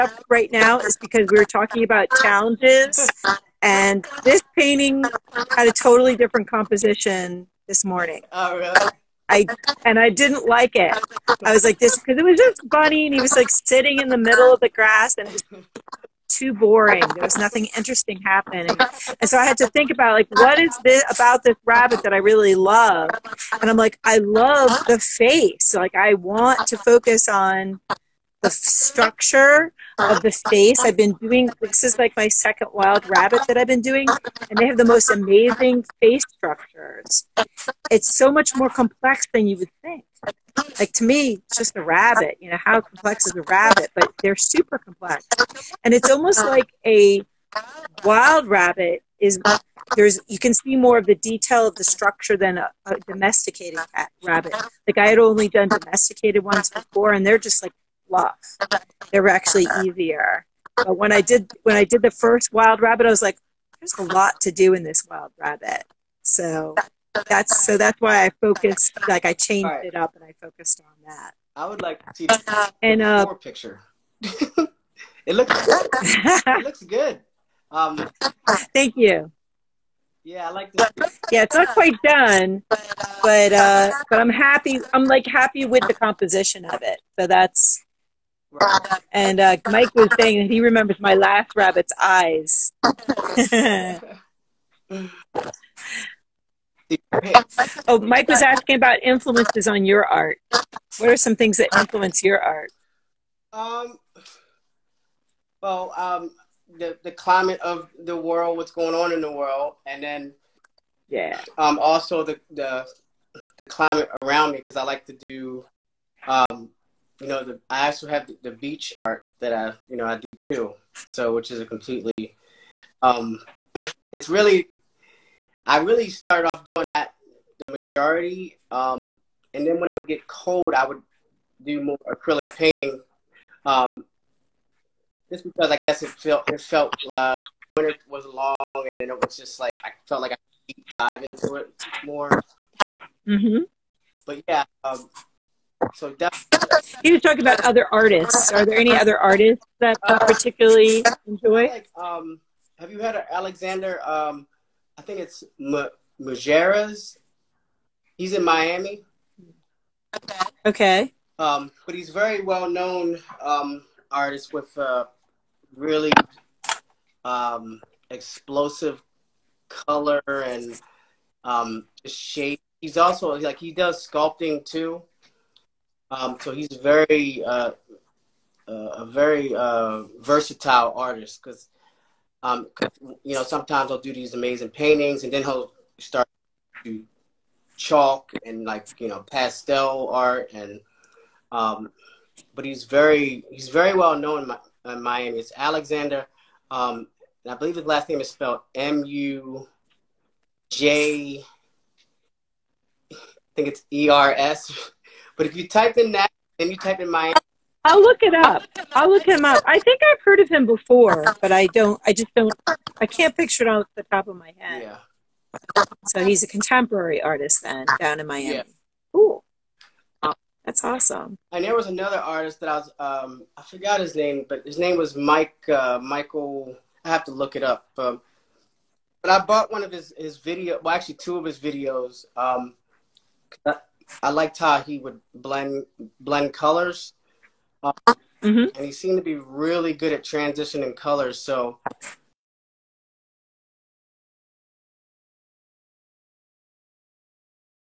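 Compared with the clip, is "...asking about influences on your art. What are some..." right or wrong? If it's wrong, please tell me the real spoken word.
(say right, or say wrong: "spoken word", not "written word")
right.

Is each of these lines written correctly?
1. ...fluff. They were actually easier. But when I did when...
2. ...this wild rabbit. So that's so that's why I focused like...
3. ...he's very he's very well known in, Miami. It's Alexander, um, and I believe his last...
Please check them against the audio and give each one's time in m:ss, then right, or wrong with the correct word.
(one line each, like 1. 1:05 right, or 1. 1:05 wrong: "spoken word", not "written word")
1. 0:58 right
2. 1:04 right
3. 3:12 right.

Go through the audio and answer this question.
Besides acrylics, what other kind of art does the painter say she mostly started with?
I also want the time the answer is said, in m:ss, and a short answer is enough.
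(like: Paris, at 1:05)
beach art, at 1:58.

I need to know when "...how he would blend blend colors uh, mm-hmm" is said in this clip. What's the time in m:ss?
3:54.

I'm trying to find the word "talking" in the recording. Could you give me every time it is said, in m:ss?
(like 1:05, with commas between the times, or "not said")
0:01, 2:27.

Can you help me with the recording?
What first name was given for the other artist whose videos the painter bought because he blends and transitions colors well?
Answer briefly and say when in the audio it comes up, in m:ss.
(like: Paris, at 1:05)
Michael, at 3:46.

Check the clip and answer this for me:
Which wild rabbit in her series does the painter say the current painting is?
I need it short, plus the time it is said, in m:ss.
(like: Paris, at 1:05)
second, at 0:32.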